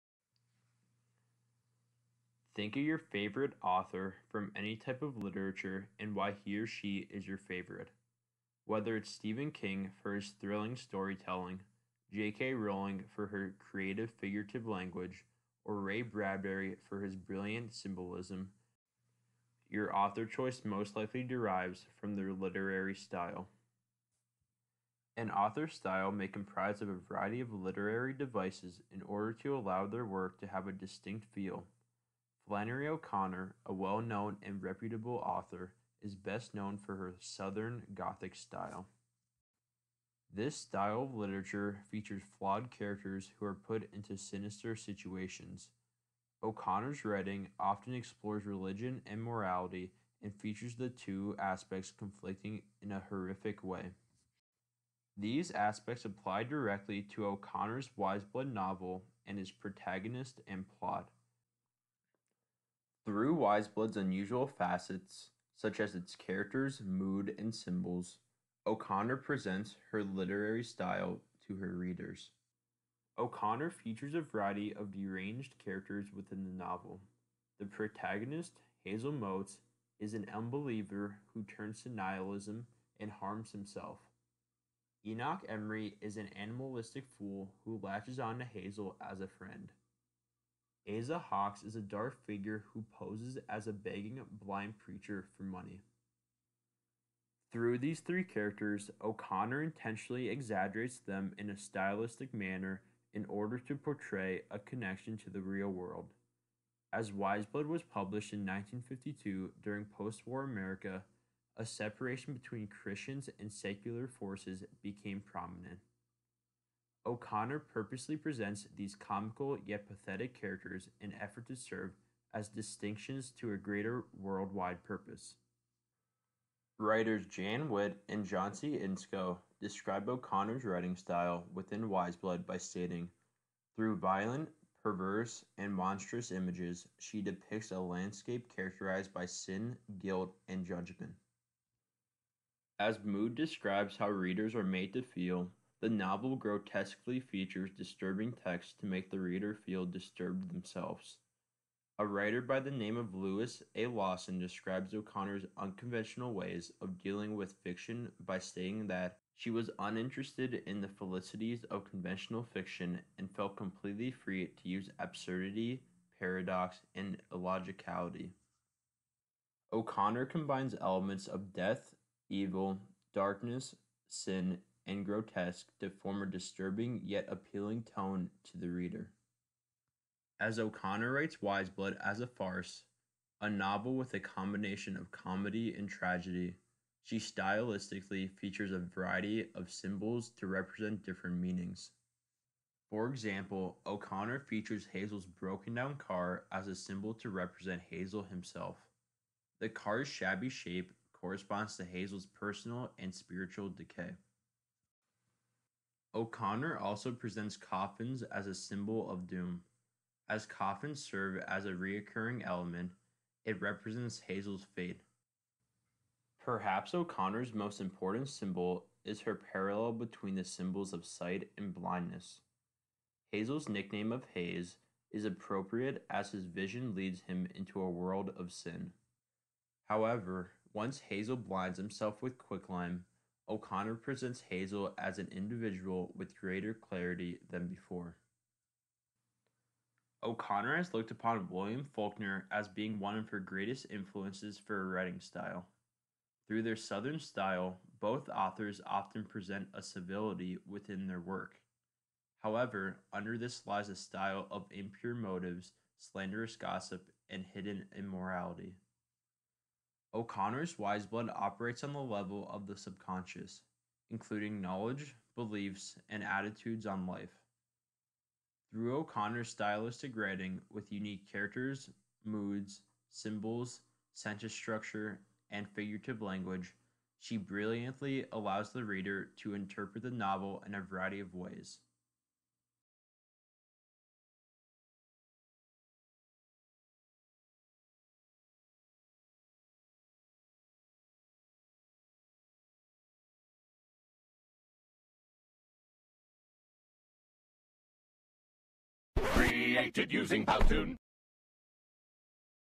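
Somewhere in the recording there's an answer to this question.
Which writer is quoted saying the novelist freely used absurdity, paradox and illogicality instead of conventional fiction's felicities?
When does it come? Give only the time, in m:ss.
2:33.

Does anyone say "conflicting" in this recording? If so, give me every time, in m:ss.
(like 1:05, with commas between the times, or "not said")
0:51.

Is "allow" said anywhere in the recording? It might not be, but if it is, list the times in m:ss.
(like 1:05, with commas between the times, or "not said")
0:29, 4:38.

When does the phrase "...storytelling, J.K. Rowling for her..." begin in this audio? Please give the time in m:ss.
0:10.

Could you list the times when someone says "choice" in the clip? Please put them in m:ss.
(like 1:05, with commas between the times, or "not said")
0:20.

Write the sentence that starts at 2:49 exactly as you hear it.
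O'Connor combines elements of death, evil, darkness, sin, and grotesque to form a disturbing yet appealing tone to the reader.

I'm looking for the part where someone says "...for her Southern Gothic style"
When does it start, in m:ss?
0:36.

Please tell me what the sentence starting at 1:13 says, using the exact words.
O'Connor features a variety of deranged characters within the novel.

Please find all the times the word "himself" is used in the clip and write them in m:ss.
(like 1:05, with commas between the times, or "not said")
1:23, 3:18, 3:51.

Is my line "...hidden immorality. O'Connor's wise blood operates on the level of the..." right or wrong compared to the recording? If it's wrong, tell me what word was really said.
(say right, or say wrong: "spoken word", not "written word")
right.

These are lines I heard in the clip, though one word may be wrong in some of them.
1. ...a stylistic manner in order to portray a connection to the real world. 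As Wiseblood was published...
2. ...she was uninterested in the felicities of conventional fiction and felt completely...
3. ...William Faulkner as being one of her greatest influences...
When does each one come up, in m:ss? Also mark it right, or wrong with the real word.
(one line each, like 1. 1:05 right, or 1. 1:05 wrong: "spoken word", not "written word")
1. 1:41 right
2. 2:39 right
3. 4:01 right.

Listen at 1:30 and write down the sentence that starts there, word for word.
Asa Hawks is a dark figure who poses as a begging blind preacher for money.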